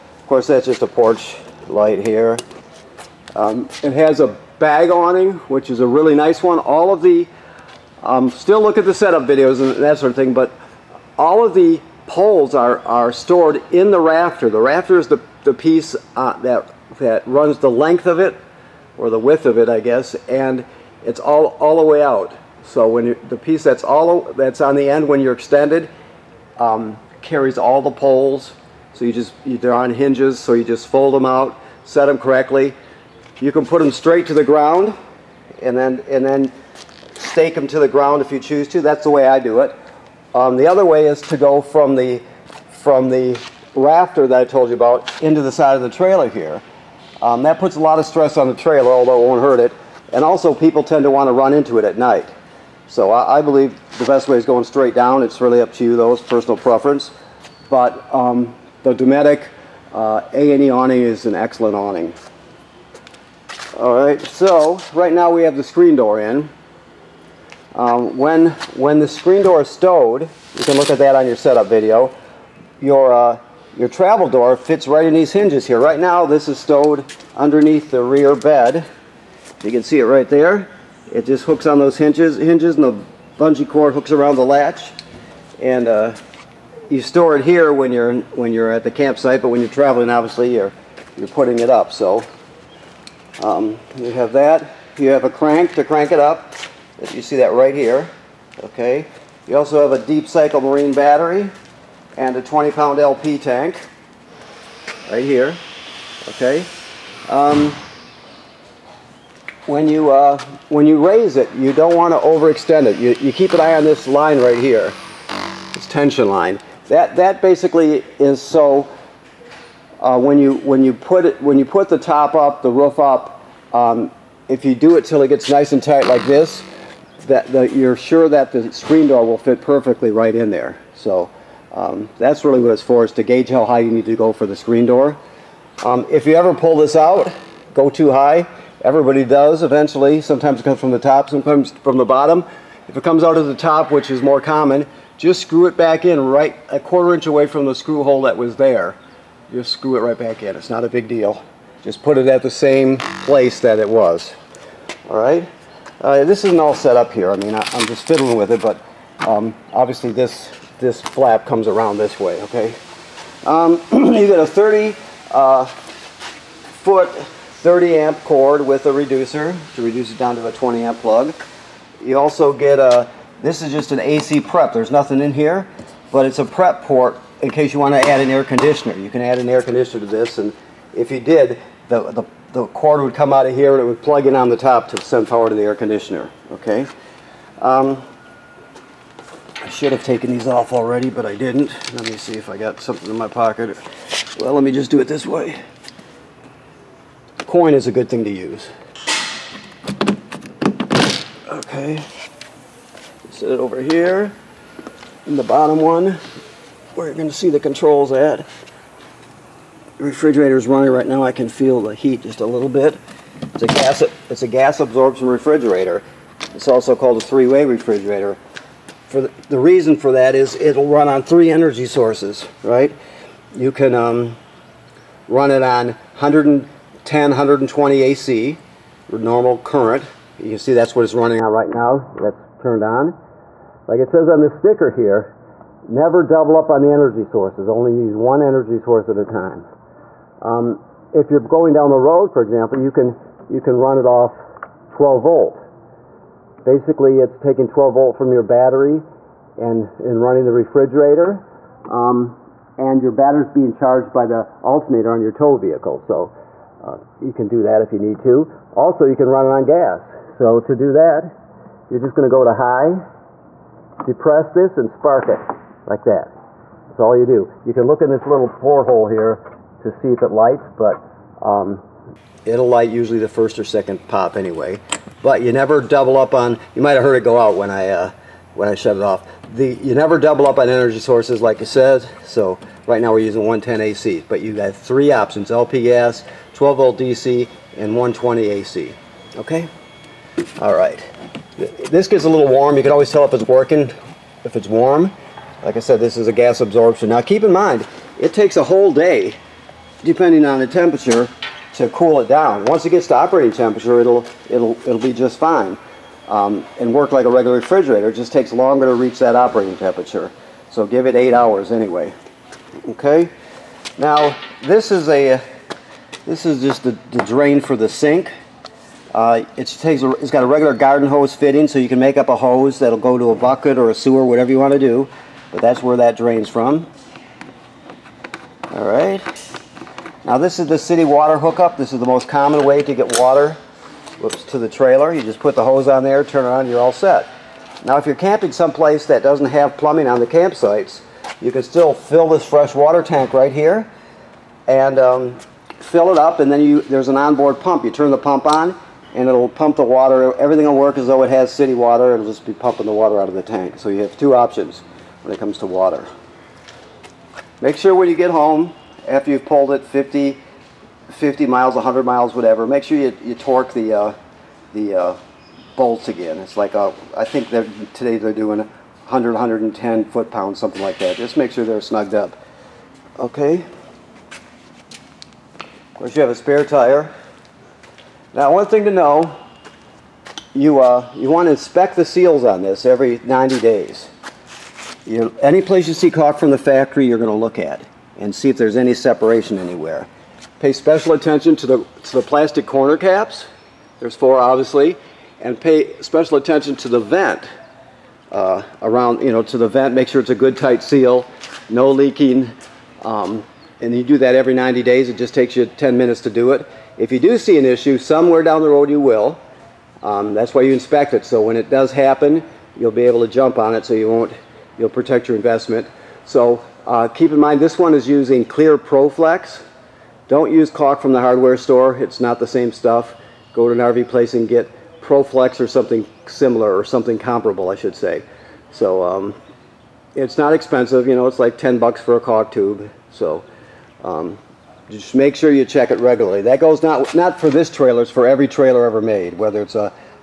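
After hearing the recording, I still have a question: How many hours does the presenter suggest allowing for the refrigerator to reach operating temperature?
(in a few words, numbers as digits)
8.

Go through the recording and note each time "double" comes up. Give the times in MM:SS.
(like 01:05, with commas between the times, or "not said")
03:56, 04:35, 04:40.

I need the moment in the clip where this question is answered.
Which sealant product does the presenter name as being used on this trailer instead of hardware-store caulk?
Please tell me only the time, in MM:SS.
06:58.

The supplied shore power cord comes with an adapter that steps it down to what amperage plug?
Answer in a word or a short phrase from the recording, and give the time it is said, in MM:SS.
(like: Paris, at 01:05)
20 amp, at 02:50.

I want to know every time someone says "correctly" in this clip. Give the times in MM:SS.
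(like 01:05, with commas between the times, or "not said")
00:32.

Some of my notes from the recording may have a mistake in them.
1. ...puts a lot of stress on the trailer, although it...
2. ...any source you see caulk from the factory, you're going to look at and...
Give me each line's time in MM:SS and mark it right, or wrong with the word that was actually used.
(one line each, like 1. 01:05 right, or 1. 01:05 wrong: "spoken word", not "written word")
1. 00:47 right
2. 06:25 wrong: "place", not "source".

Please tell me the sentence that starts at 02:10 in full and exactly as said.
So um, that's really what it's for, is to gauge how high you need to go for the screen door.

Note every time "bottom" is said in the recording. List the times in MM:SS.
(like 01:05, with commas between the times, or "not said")
02:22, 03:25.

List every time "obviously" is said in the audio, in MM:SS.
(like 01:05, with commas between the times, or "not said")
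01:30, 02:39, 06:34.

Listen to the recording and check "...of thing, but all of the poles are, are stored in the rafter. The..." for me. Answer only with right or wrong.
right.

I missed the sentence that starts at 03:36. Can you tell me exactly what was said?
It's also called a three-way refrigerator the reason for that is it'll run on three energy sources, right?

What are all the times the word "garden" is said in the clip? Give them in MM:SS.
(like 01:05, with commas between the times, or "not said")
05:20.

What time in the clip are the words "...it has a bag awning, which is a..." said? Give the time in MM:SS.
00:03.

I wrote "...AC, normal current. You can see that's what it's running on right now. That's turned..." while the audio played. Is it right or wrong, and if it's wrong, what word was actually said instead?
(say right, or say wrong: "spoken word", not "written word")
right.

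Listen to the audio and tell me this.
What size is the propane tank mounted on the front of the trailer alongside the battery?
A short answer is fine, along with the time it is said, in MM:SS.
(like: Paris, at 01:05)
20 pound, at 01:42.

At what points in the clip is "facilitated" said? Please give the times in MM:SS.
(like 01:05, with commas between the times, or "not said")
not said.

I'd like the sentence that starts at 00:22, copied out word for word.
So when you, the piece that's all that's on the end when you're extended um, carries all the poles.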